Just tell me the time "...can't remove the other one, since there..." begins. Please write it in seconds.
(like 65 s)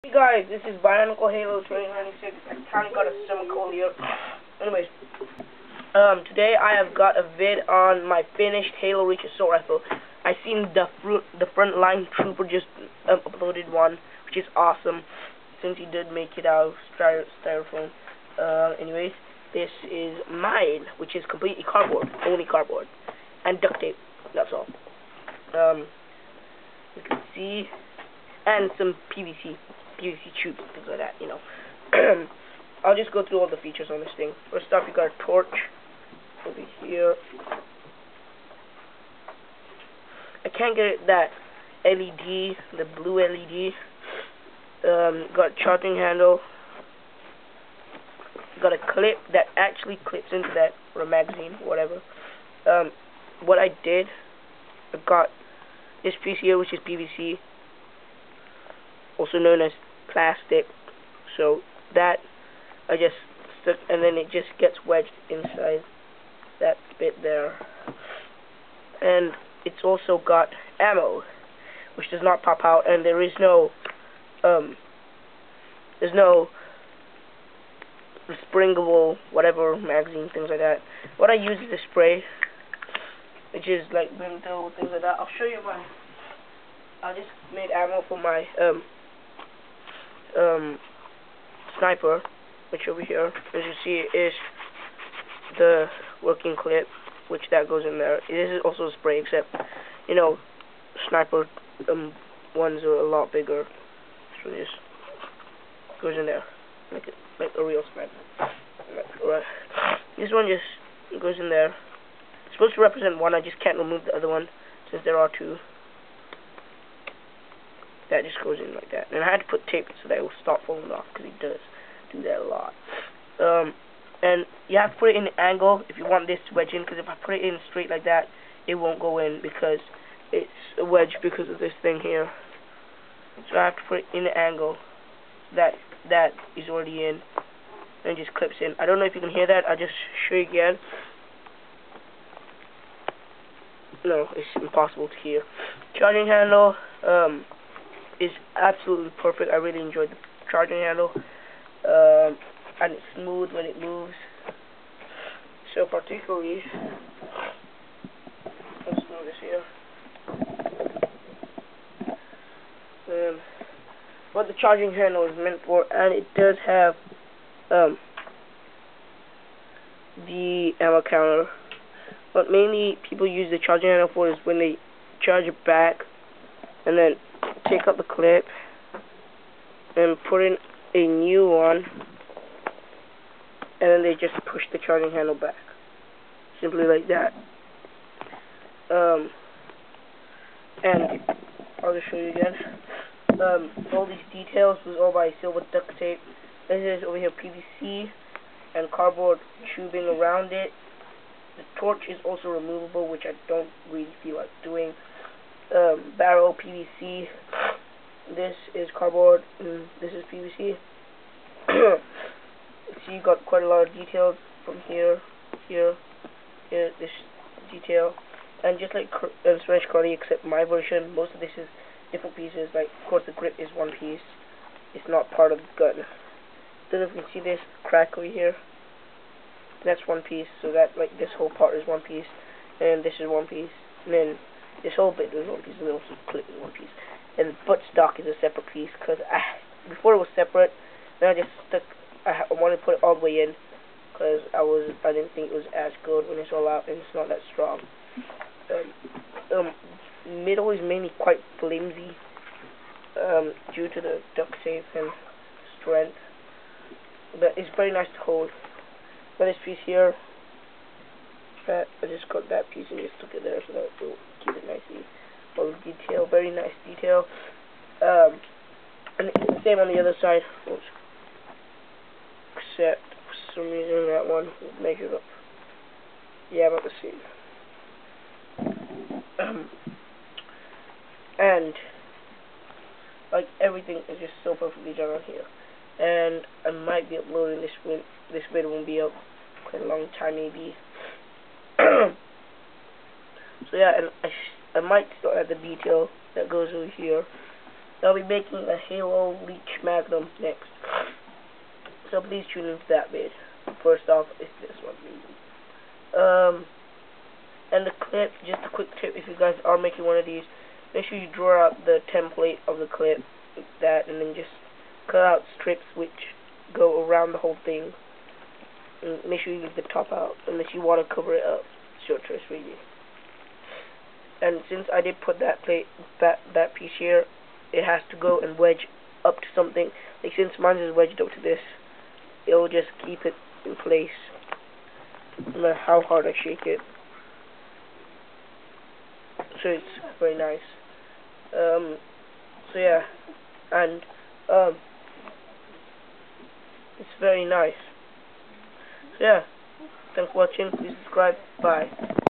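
113 s.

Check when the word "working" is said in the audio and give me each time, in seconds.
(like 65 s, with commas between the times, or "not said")
96 s.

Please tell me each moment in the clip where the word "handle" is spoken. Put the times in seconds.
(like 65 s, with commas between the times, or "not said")
45 s, 146 s, 150 s, 164 s, 173 s, 185 s.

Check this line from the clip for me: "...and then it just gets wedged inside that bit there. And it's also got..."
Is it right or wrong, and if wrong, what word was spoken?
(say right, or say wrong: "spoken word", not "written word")
right.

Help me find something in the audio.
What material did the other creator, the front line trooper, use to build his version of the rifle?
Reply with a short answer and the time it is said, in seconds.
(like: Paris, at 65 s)
Styrofoam, at 16 s.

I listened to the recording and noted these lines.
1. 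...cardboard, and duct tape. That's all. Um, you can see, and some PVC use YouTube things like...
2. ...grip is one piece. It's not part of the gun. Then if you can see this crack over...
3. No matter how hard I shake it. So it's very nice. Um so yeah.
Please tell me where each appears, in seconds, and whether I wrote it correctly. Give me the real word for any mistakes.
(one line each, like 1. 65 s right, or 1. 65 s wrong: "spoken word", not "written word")
1. 22 s right
2. 223 s right
3. 335 s right.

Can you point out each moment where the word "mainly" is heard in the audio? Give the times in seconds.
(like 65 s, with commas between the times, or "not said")
172 s, 250 s.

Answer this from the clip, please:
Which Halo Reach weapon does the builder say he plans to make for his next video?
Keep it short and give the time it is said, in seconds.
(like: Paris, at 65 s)
Magnum, at 298 s.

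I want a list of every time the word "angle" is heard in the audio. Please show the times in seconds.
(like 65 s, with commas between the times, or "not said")
125 s, 134 s.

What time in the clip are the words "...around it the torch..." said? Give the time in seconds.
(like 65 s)
200 s.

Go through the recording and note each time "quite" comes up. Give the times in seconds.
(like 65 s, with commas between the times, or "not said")
213 s, 251 s, 289 s.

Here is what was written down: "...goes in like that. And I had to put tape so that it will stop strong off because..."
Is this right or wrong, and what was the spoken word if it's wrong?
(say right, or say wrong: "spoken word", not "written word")
wrong: "falling", not "strong".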